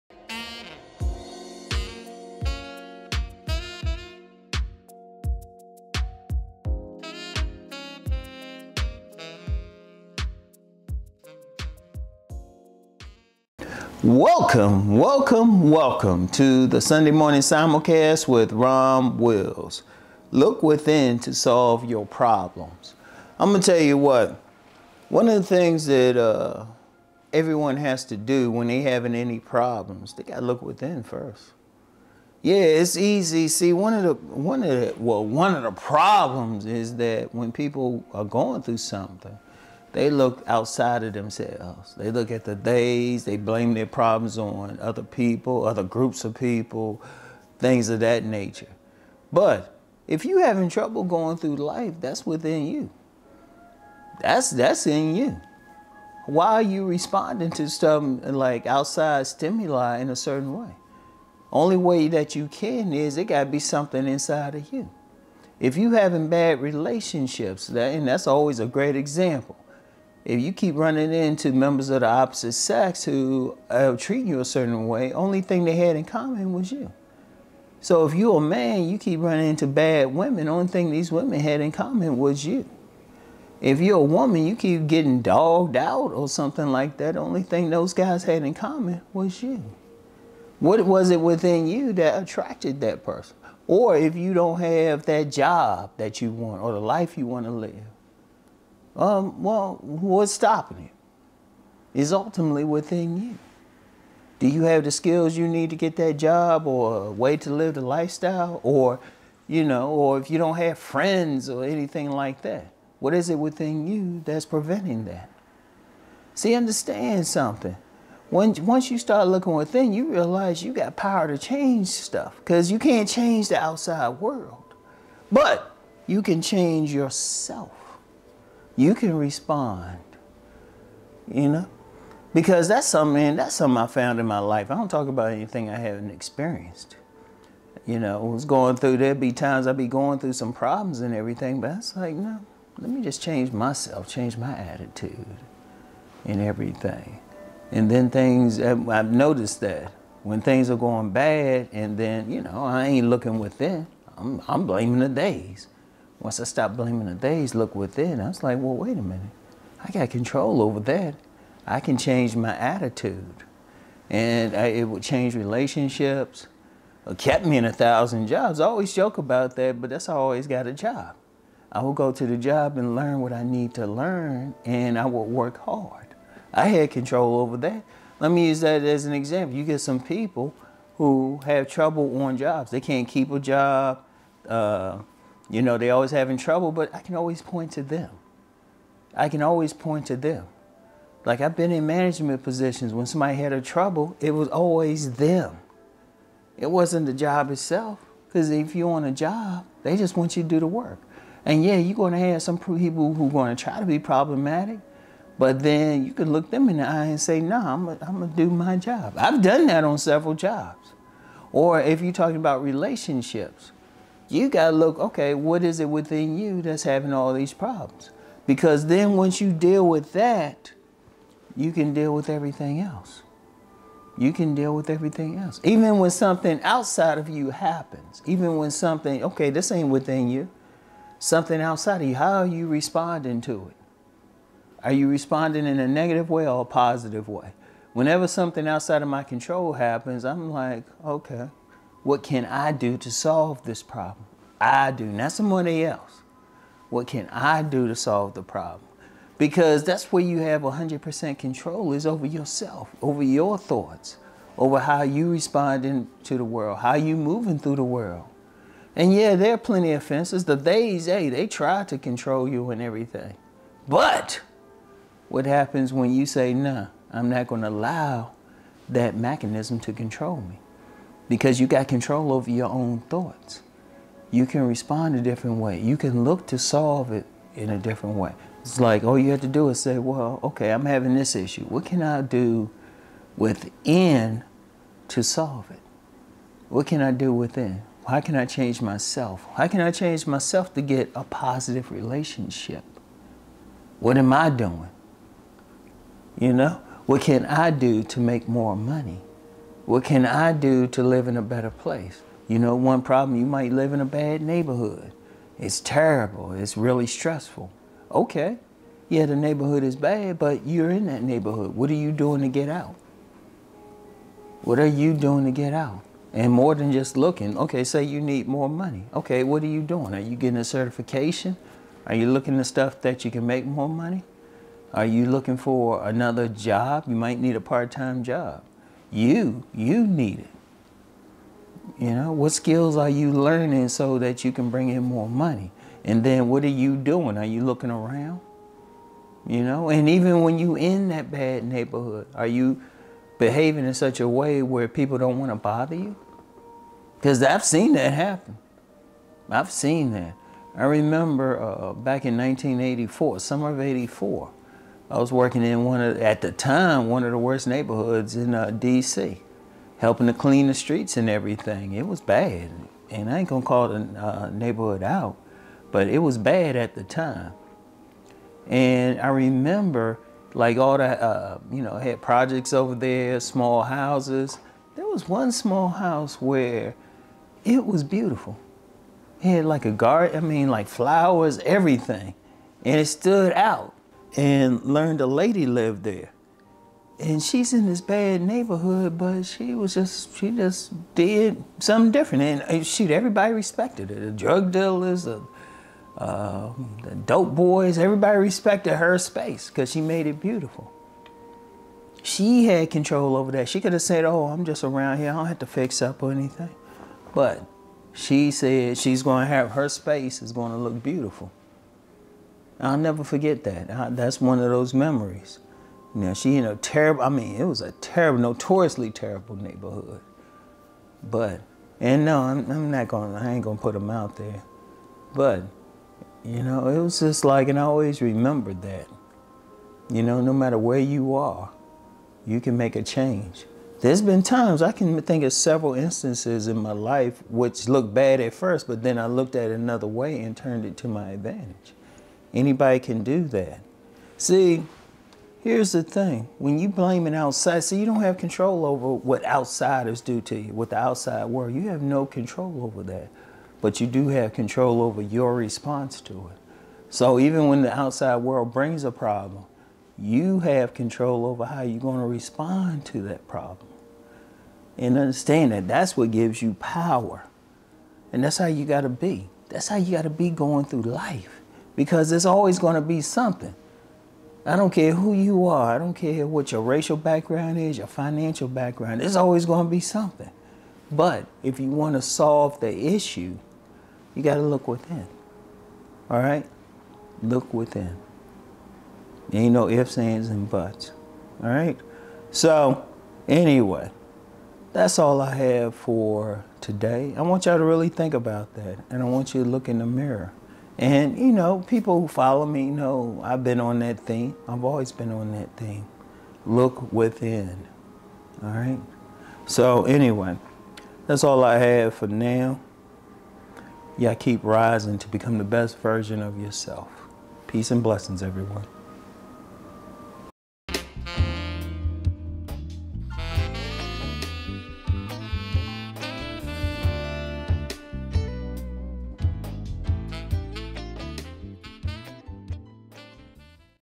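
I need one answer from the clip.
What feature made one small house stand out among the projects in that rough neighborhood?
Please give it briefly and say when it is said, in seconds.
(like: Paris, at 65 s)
a garden, at 379 s.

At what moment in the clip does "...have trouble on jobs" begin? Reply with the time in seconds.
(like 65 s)
181 s.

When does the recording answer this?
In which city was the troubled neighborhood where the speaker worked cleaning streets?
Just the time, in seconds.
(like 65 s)
358 s.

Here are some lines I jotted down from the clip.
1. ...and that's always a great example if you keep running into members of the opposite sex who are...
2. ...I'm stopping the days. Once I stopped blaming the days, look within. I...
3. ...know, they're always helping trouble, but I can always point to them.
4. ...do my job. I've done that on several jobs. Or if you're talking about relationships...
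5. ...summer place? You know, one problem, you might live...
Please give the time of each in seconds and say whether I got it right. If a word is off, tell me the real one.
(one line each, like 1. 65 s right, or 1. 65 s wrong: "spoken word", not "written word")
1. 67 s right
2. 154 s wrong: "blaming", not "stopping"
3. 185 s wrong: "having", not "helping"
4. 208 s right
5. 301 s wrong: "better", not "summer".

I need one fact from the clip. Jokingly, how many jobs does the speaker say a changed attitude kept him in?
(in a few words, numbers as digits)
1000.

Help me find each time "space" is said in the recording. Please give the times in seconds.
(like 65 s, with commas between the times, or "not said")
399 s, 409 s.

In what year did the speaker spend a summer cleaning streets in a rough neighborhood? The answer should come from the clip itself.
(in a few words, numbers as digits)
1984.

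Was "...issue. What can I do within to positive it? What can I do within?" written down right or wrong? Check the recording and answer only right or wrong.
wrong.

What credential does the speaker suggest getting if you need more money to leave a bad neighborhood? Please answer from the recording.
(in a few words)
a certification.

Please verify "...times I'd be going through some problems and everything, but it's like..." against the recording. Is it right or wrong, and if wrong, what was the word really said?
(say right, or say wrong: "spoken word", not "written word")
right.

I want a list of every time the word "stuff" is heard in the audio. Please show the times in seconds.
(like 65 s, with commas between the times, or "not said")
121 s, 322 s.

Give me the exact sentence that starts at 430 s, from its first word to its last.
You know, no matter where you are, you can make a change.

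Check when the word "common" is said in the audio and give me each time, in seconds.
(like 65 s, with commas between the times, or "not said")
76 s, 81 s, 88 s.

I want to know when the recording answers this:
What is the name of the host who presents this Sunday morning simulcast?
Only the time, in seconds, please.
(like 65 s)
18 s.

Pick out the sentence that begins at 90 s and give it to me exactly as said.
What was it within you that attracted that person?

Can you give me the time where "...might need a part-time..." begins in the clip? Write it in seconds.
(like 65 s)
327 s.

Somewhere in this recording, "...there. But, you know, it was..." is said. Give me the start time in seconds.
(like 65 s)
424 s.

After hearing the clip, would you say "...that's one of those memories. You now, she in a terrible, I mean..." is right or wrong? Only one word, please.
right.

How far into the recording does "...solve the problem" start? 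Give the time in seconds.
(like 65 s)
247 s.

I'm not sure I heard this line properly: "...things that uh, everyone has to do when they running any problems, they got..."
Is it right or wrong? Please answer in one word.
wrong.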